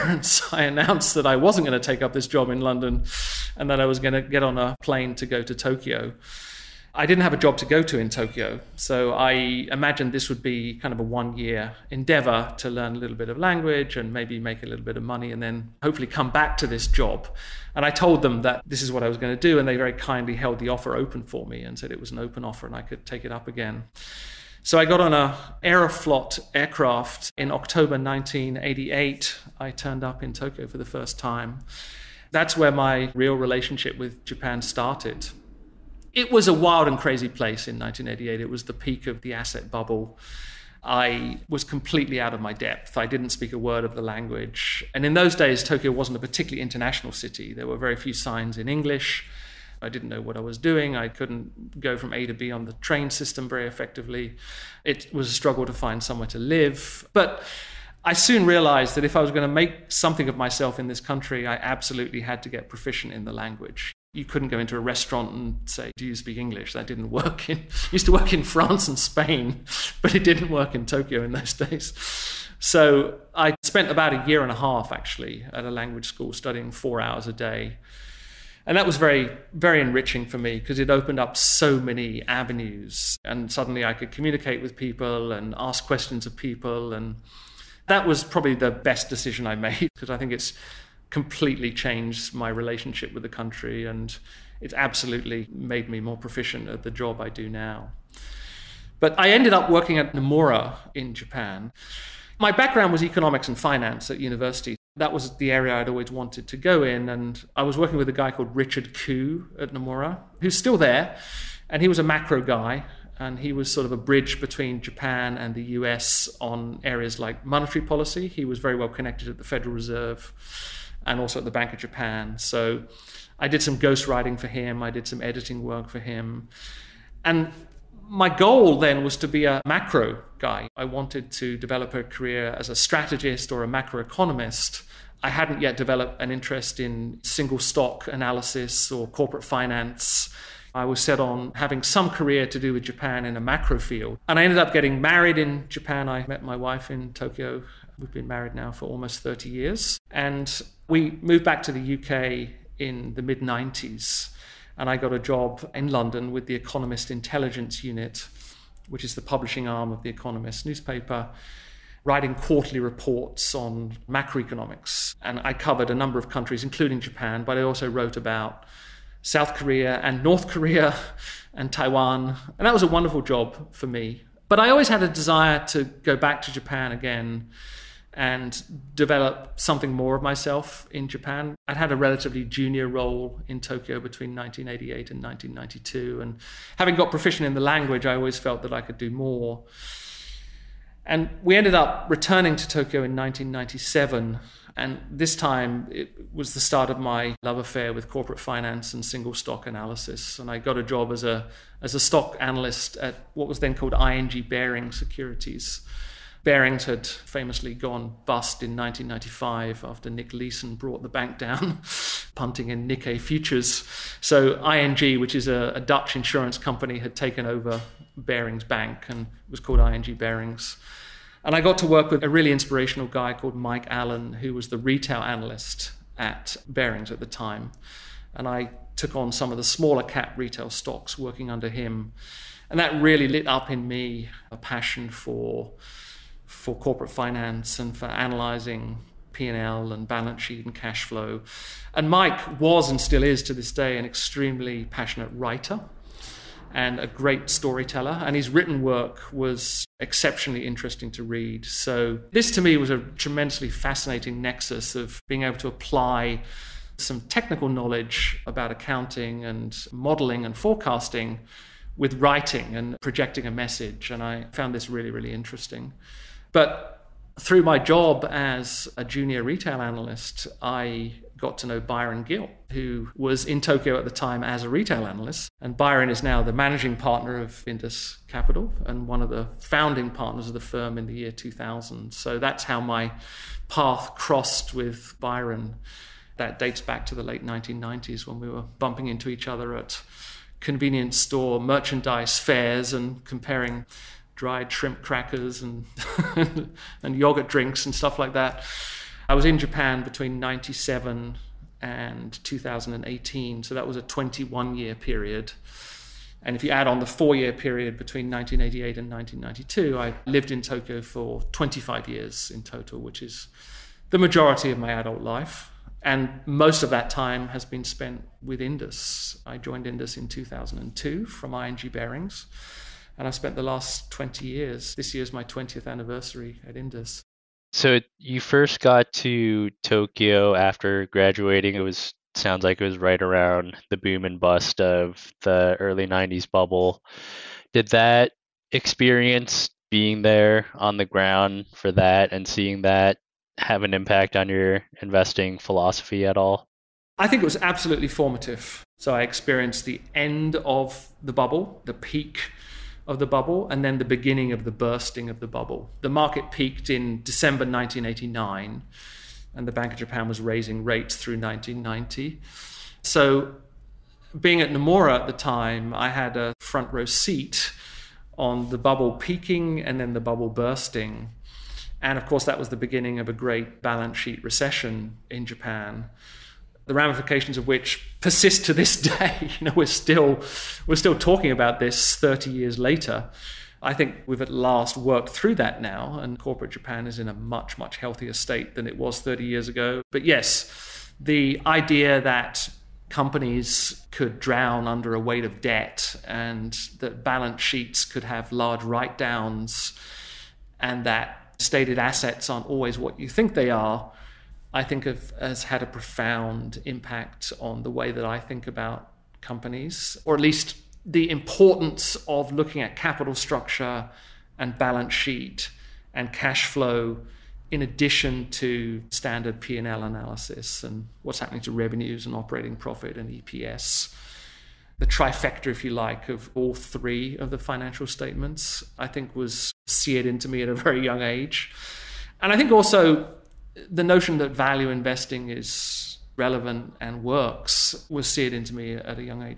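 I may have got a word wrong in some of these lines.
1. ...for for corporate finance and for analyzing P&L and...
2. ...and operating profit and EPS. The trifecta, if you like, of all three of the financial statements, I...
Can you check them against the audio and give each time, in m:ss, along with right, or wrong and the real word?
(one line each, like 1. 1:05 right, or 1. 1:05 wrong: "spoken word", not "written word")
1. 3:55 right
2. 7:02 right.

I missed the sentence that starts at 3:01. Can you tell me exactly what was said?
I'd had a relatively junior role in Tokyo between 1988 and 1992.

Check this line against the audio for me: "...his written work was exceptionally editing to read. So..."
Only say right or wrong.
wrong.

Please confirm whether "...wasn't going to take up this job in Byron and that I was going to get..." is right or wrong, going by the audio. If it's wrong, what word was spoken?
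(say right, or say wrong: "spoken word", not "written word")
wrong: "London", not "Byron".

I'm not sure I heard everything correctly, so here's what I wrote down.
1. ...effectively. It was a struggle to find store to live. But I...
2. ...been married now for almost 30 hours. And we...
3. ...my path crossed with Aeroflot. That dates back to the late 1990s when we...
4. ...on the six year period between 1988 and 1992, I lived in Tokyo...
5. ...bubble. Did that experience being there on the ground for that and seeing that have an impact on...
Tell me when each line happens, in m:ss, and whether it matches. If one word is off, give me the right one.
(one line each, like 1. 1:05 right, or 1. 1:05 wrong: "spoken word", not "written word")
1. 0:53 wrong: "somewhere", not "store"
2. 2:28 wrong: "years", not "hours"
3. 4:42 wrong: "Byron", not "Aeroflot"
4. 5:06 wrong: "four", not "six"
5. 5:36 right.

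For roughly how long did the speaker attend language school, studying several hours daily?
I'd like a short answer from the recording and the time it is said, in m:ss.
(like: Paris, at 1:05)
a year and a half, at 1:14.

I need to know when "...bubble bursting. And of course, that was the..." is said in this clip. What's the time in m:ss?
6:10.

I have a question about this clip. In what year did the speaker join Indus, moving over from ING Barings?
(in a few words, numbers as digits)
2002.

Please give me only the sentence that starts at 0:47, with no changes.
There were very few signs in English.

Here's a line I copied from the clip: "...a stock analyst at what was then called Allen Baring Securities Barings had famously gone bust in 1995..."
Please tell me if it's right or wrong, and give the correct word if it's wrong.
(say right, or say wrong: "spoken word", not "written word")
wrong: "ING", not "Allen".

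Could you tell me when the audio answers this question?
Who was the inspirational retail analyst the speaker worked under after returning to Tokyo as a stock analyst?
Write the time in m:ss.
3:43.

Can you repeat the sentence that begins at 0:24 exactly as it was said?
So I got on a Aeroflot aircraft in October 1988.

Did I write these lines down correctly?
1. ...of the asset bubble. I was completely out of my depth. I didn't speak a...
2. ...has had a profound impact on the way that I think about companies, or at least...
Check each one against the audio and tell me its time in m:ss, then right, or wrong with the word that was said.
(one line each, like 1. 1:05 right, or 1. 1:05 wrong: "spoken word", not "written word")
1. 0:39 right
2. 6:45 right.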